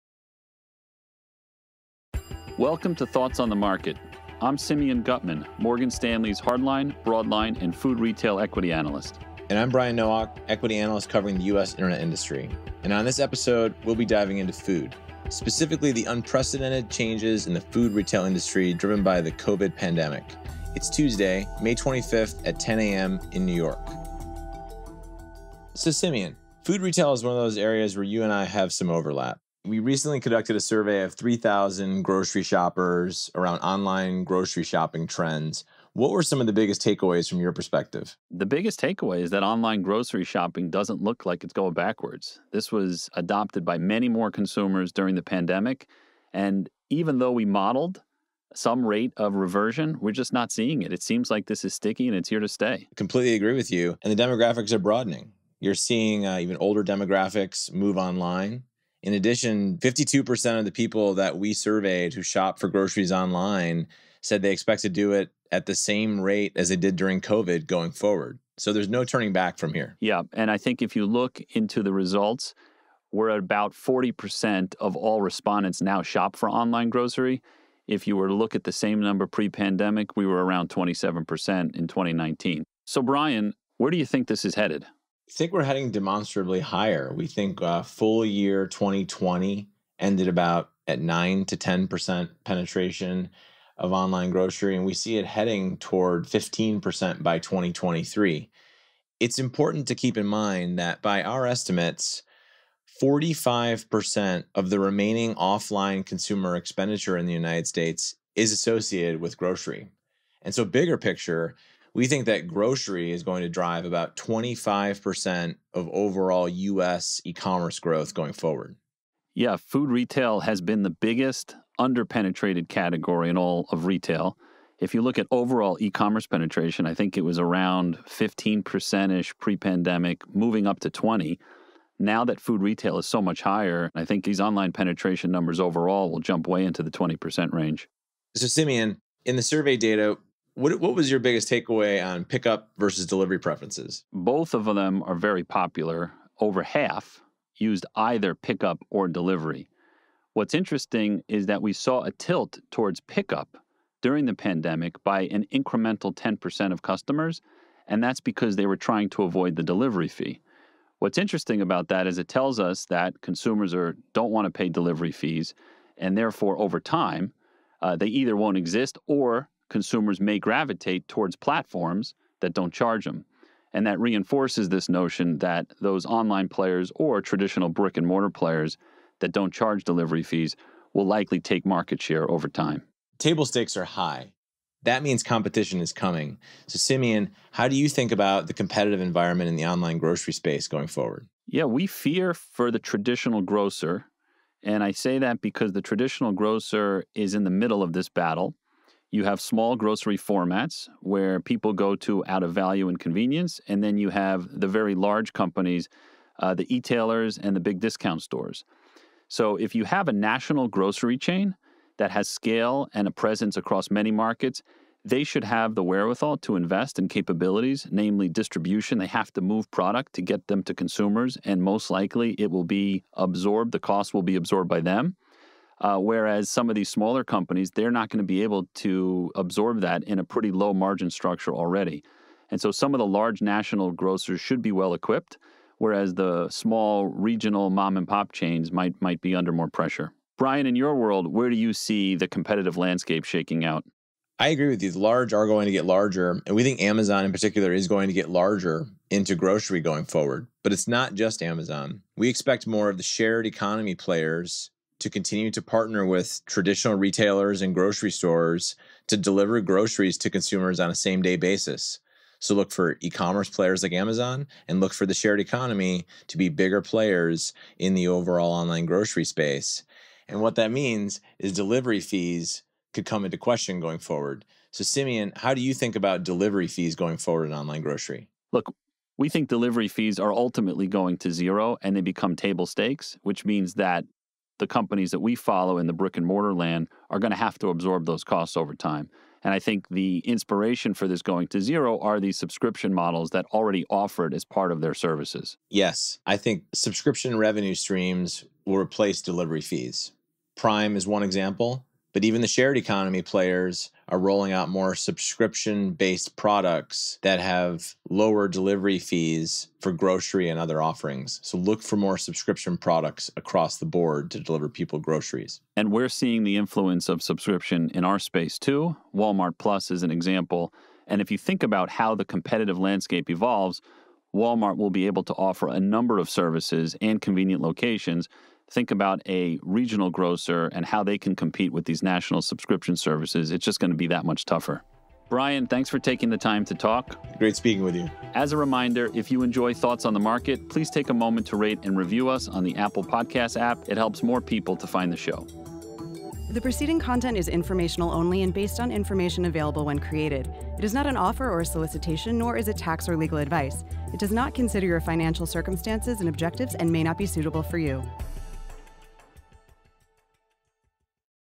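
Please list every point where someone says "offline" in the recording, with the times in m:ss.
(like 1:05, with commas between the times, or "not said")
1:45.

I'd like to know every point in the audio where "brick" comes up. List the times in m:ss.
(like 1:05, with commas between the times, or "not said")
2:57, 4:45.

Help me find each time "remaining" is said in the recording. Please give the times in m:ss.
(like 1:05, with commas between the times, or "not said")
1:44.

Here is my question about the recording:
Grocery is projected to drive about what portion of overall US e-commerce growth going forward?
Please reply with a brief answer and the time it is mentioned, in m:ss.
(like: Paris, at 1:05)
25%, at 1:54.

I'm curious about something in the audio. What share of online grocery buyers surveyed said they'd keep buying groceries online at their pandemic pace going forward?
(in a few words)
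52%.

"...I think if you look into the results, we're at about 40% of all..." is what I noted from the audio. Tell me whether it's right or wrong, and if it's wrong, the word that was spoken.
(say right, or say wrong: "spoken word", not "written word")
right.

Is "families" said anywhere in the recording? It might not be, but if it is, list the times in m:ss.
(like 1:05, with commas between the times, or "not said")
not said.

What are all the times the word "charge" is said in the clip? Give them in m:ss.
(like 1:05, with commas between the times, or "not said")
2:52, 2:59.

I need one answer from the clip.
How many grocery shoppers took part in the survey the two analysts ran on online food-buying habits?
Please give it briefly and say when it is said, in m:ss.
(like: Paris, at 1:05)
3,000, at 0:31.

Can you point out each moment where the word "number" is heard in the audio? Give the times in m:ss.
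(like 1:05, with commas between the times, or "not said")
1:18, 2:15, 5:25.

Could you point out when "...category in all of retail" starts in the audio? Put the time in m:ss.
2:02.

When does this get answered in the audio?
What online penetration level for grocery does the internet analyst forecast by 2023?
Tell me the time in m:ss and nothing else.
1:36.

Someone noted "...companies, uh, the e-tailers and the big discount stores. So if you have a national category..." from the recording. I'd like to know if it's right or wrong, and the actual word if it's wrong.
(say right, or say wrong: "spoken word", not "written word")
wrong: "grocery", not "category".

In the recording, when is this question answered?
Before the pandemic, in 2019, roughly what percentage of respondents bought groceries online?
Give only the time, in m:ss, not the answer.
1:20.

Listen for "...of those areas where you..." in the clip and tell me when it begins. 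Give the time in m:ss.
0:27.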